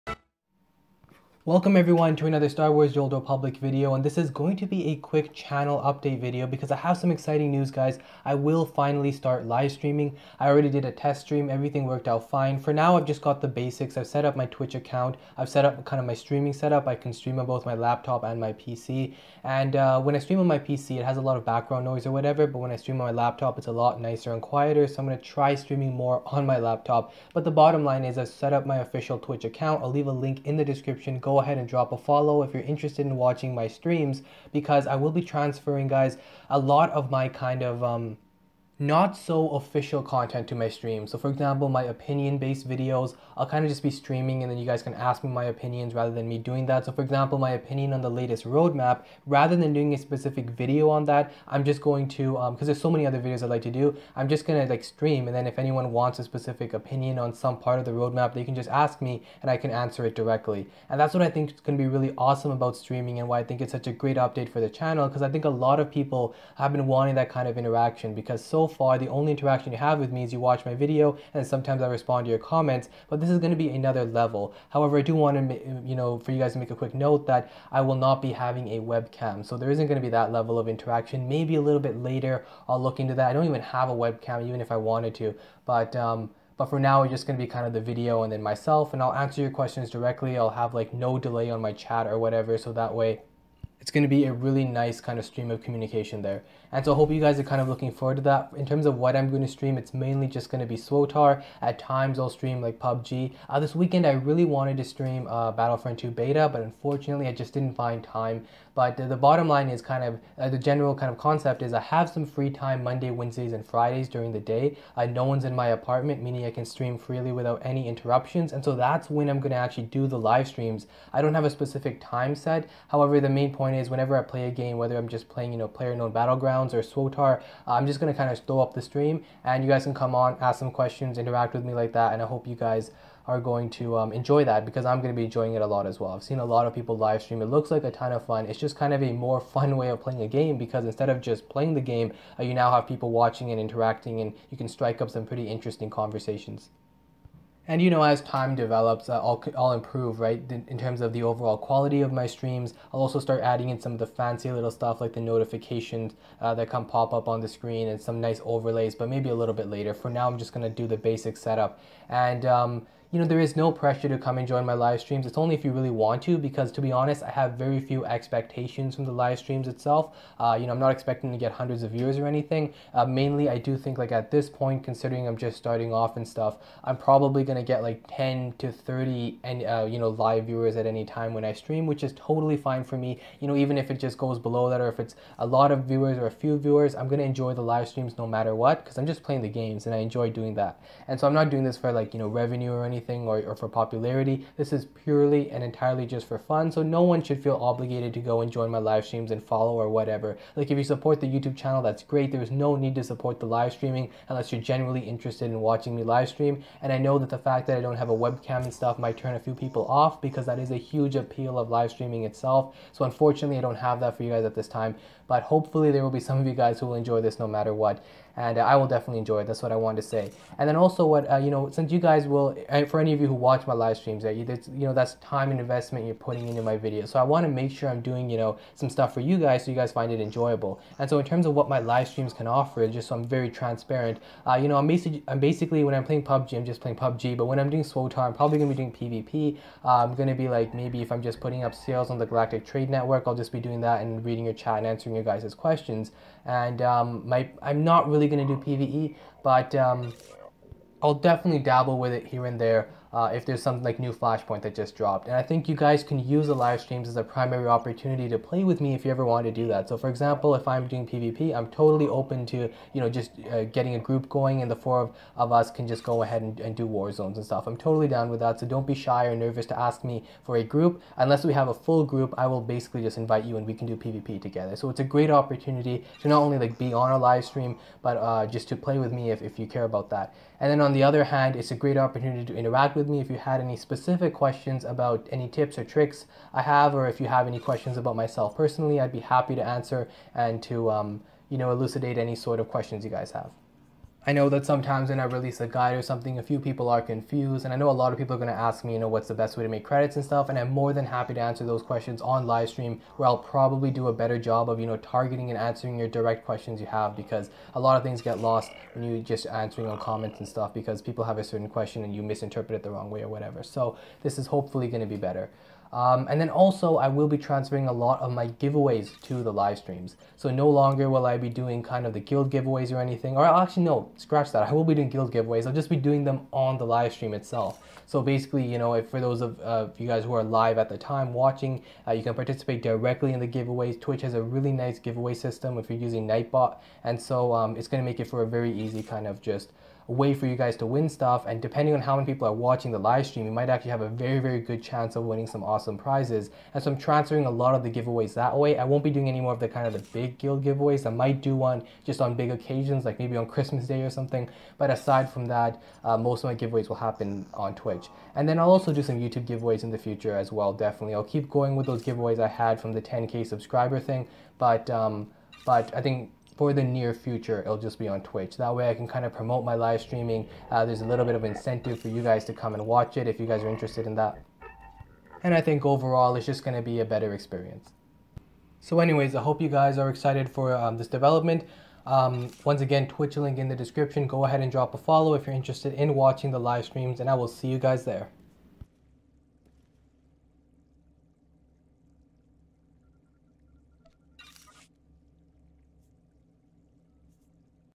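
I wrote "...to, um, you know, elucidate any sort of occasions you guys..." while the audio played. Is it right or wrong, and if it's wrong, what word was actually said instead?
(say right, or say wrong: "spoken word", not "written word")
wrong: "questions", not "occasions".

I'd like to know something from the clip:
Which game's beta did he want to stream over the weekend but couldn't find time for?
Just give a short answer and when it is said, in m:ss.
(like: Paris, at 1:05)
Battlefront 2, at 1:45.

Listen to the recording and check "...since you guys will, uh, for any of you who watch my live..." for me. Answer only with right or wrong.
right.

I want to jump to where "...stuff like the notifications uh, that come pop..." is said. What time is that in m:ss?
2:34.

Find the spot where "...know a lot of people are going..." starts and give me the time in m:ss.
4:57.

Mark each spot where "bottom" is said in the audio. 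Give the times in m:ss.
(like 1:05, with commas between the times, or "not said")
0:27, 1:49.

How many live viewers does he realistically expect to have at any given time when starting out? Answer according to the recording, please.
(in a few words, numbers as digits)
10 to 30.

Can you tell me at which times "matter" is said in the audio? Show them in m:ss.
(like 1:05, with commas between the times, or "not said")
3:08, 3:37.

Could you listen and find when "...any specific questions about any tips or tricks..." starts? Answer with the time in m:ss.
4:43.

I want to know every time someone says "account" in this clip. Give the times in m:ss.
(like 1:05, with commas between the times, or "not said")
0:14, 0:29.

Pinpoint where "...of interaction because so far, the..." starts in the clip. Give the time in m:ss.
1:07.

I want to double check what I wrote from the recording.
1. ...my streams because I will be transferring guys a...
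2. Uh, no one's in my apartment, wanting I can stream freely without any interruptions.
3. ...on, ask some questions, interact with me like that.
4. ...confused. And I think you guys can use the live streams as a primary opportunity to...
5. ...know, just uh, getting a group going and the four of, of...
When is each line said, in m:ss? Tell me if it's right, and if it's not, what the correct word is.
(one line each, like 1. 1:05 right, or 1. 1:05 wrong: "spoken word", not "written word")
1. 0:33 right
2. 1:54 wrong: "meaning", not "wanting"
3. 2:10 right
4. 4:14 wrong: "dropped", not "confused"
5. 4:23 right.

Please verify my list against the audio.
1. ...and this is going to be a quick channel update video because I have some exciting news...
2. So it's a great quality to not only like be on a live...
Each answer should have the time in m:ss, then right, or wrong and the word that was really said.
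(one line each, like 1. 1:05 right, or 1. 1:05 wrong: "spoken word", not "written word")
1. 0:03 right
2. 4:34 wrong: "opportunity", not "quality".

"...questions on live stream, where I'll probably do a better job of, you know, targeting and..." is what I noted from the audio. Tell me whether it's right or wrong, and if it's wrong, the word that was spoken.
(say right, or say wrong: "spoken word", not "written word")
right.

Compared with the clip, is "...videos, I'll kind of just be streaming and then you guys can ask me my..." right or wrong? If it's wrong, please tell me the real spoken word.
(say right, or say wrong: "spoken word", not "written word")
right.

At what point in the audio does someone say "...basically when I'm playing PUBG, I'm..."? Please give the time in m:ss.
3:55.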